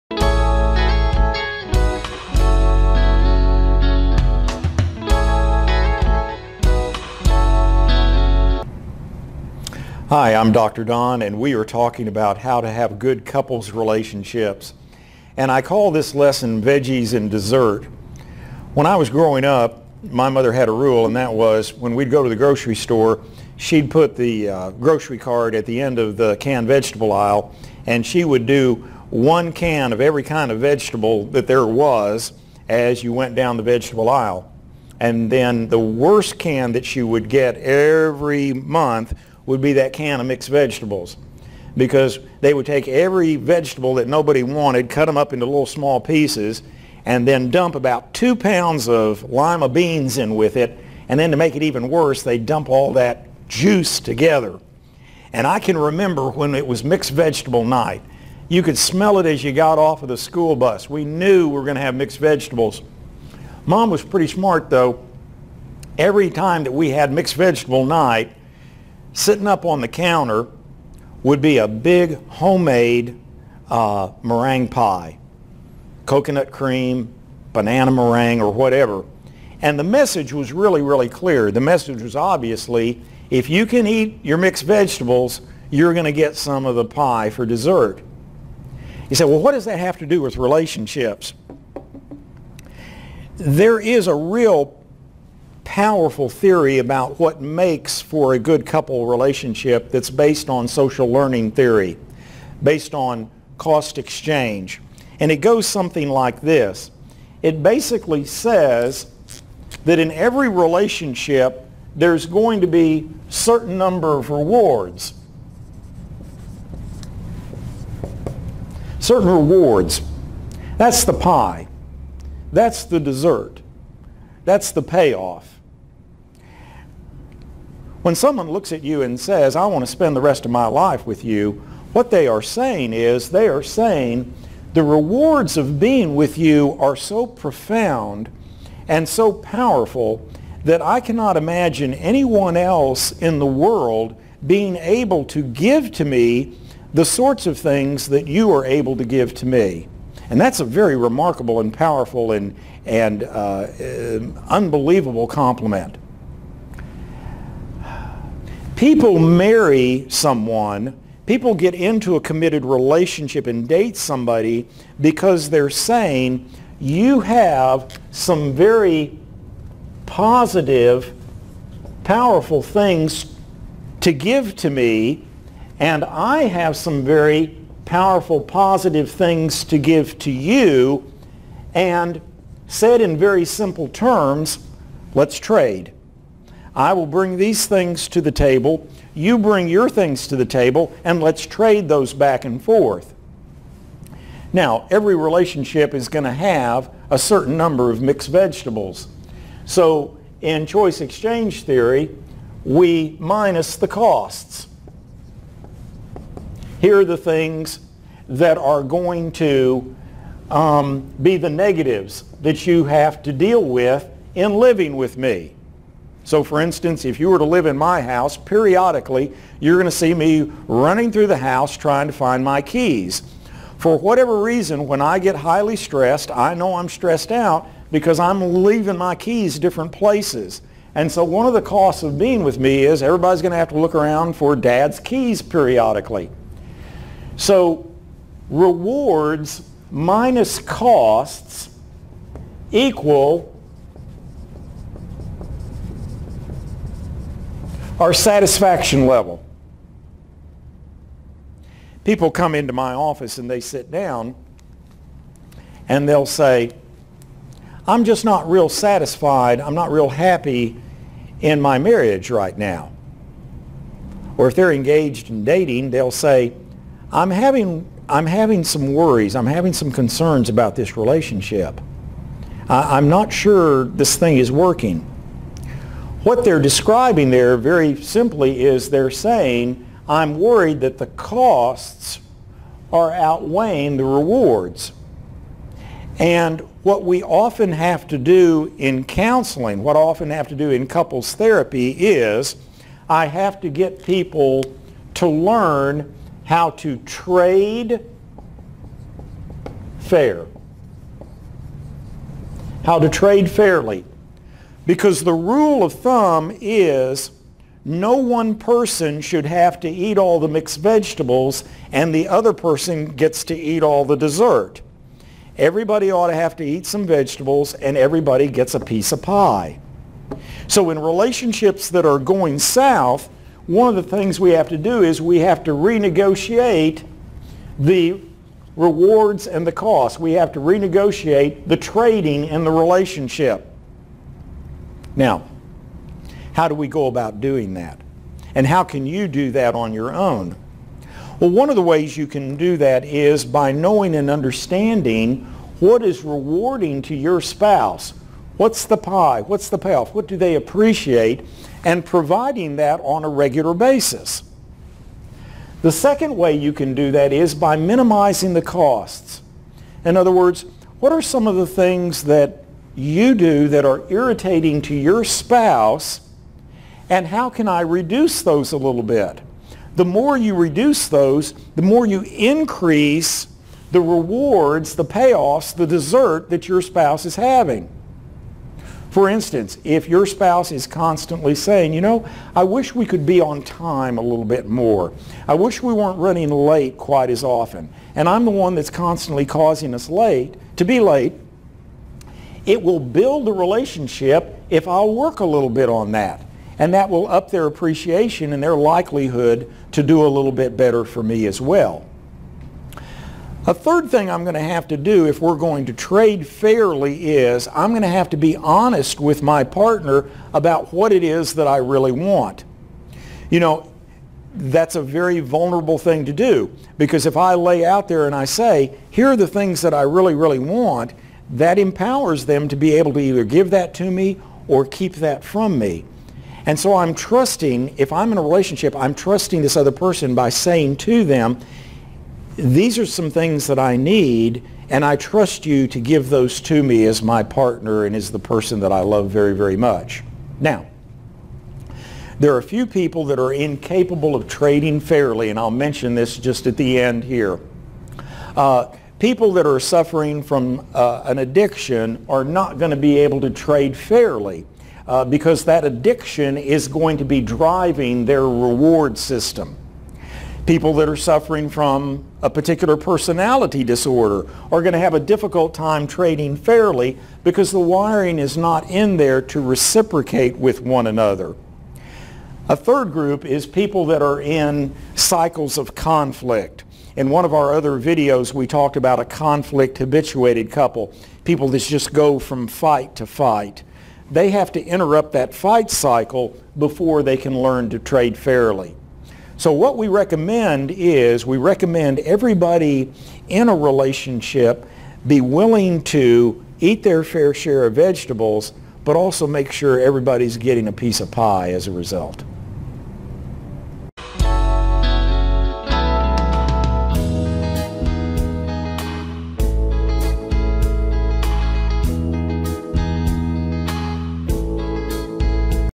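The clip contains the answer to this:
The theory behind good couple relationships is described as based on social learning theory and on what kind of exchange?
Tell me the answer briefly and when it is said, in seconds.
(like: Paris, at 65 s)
Cost exchange, at 103 s.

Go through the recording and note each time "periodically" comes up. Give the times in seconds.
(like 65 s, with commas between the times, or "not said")
218 s, 235 s.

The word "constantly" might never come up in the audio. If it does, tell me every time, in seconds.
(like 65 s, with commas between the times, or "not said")
380 s, 388 s.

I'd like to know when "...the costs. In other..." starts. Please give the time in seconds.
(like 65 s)
358 s.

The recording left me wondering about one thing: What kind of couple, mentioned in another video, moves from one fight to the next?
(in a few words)
Conflict habituated couple.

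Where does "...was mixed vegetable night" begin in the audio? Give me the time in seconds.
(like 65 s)
56 s.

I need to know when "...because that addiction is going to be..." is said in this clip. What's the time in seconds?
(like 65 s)
455 s.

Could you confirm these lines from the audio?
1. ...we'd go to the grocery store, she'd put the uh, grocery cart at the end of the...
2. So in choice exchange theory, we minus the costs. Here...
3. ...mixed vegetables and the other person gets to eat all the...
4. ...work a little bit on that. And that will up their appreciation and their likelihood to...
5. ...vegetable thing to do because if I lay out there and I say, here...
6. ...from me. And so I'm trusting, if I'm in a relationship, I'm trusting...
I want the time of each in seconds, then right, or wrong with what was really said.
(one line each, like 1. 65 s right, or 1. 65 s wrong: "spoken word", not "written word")
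1. 21 s right
2. 199 s right
3. 310 s right
4. 395 s right
5. 415 s wrong: "vulnerable", not "vegetable"
6. 425 s right.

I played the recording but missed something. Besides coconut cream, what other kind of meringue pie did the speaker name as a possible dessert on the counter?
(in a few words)
Banana.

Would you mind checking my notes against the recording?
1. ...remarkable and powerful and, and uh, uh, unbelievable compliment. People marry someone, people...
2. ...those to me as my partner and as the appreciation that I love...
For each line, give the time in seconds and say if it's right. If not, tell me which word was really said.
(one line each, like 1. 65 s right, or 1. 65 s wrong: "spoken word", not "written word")
1. 150 s right
2. 436 s wrong: "person", not "appreciation".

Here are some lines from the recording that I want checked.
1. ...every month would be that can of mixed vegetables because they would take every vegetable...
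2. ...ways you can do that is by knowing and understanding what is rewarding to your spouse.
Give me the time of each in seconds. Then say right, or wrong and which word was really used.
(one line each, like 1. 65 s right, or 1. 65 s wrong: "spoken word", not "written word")
1. 37 s right
2. 341 s right.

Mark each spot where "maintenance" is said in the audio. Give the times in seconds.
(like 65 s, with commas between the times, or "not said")
not said.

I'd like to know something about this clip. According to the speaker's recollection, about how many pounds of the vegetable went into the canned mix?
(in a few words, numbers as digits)
2.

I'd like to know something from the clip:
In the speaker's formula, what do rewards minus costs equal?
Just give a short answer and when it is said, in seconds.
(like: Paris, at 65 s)
Satisfaction level, at 248 s.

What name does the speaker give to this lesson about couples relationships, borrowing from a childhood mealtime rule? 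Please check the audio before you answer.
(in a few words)
Veggies and dessert.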